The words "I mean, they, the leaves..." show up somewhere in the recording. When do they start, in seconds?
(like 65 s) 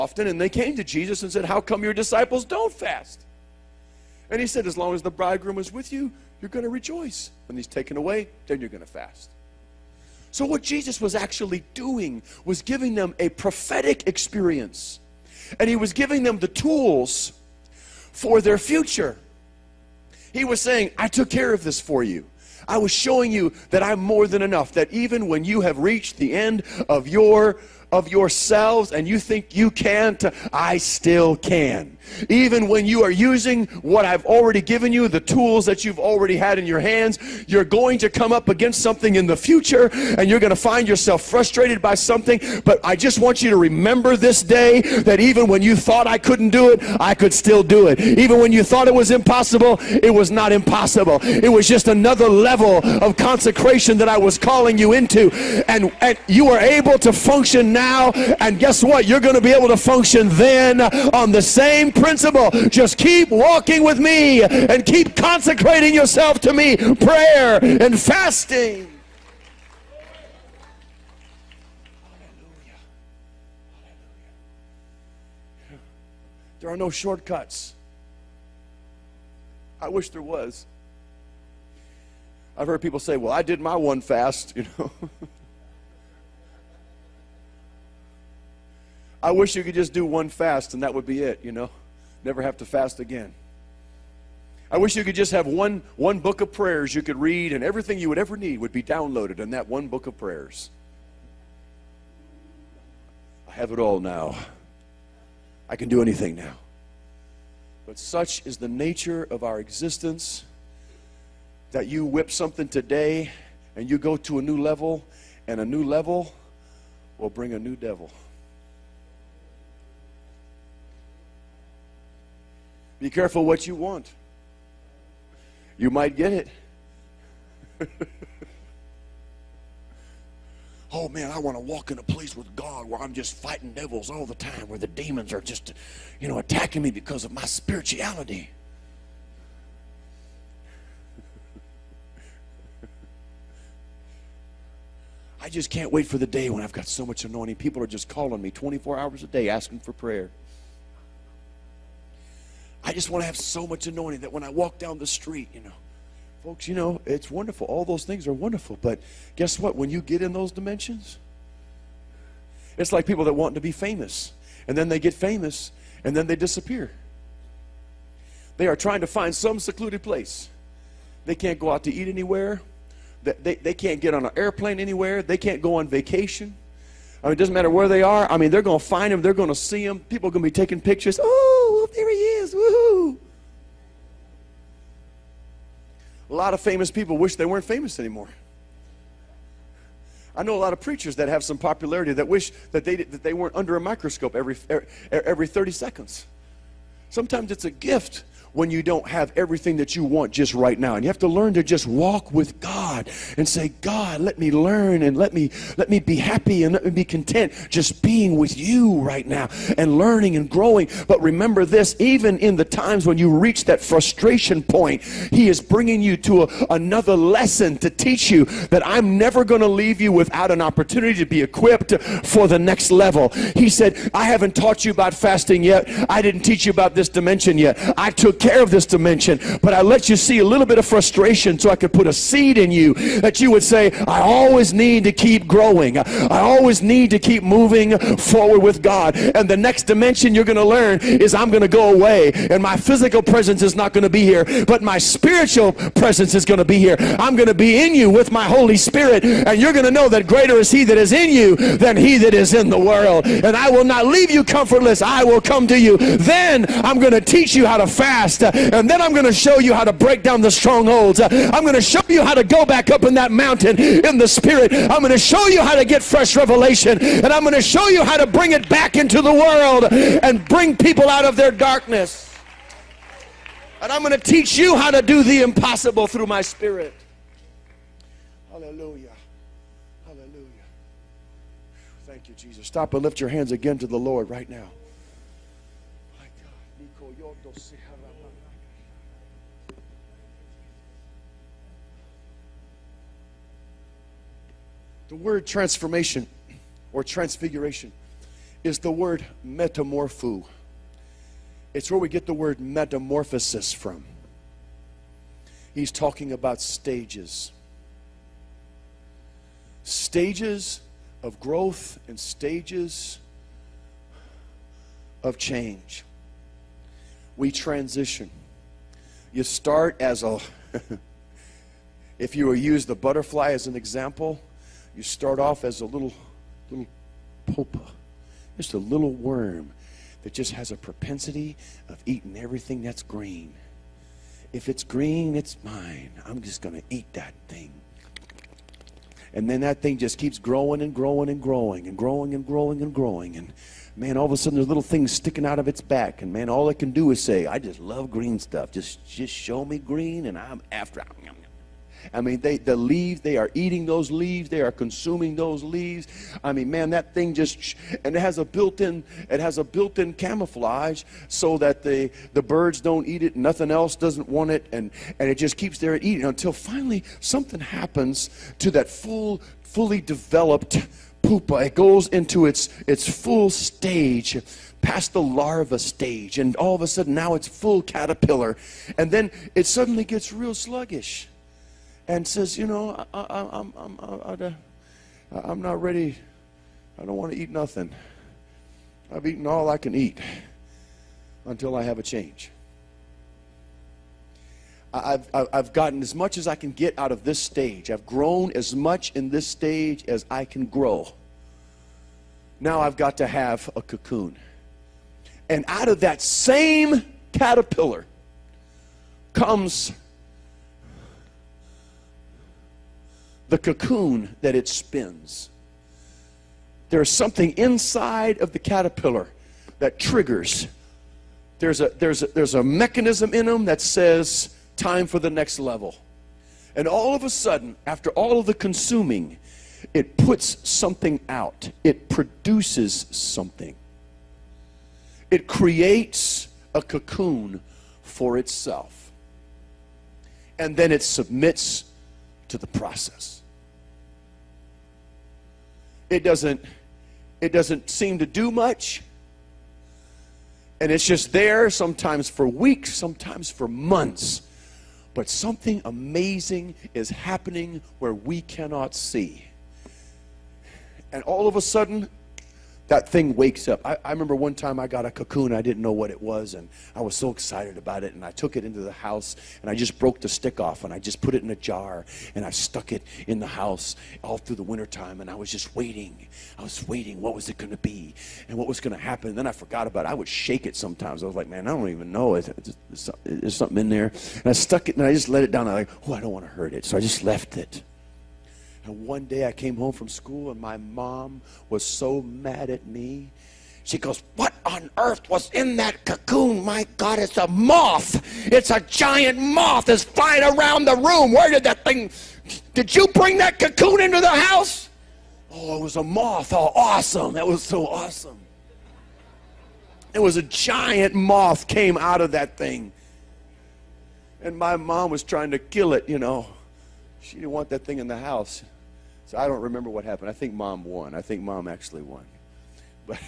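352 s.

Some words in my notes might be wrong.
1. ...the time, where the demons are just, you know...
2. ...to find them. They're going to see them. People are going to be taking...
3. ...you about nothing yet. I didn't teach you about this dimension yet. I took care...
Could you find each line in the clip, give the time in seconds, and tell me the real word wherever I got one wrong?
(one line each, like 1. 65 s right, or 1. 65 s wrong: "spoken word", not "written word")
1. 134 s right
2. 178 s right
3. 224 s wrong: "fasting", not "nothing".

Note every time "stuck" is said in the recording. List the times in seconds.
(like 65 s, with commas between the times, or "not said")
472 s, 484 s.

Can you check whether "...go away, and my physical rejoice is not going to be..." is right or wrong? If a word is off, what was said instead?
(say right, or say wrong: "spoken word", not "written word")
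wrong: "presence", not "rejoice".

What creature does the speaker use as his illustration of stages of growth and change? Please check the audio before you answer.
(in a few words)
The butterfly.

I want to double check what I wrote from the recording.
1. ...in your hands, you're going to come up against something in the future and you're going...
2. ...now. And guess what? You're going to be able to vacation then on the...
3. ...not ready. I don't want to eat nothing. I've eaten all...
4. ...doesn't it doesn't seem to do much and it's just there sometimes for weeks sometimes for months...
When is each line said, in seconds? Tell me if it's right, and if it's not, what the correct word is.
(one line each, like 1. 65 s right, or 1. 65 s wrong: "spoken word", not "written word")
1. 36 s right
2. 57 s wrong: "function", not "vacation"
3. 385 s right
4. 446 s right.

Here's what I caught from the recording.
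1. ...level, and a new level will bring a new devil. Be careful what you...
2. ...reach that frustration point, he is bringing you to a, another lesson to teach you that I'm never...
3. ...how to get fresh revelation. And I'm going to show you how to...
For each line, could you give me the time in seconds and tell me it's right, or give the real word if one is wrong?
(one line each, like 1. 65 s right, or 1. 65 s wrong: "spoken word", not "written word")
1. 114 s right
2. 213 s right
3. 265 s right.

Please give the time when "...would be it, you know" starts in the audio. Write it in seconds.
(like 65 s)
90 s.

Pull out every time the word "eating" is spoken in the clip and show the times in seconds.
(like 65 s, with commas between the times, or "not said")
332 s, 353 s, 365 s.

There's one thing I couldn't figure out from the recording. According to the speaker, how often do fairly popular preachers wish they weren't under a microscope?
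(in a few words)
Every 30 seconds.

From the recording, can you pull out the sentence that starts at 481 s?
I was like, man, I don't even know.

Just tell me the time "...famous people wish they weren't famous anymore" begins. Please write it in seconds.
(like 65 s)
186 s.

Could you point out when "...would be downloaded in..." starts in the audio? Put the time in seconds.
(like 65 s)
98 s.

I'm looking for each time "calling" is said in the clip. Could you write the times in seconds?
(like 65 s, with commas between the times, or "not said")
54 s, 148 s.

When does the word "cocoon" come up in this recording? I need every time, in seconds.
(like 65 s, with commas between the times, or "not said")
403 s, 413 s, 436 s, 465 s, 496 s, 503 s.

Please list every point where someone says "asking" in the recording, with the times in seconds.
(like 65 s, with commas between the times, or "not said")
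149 s.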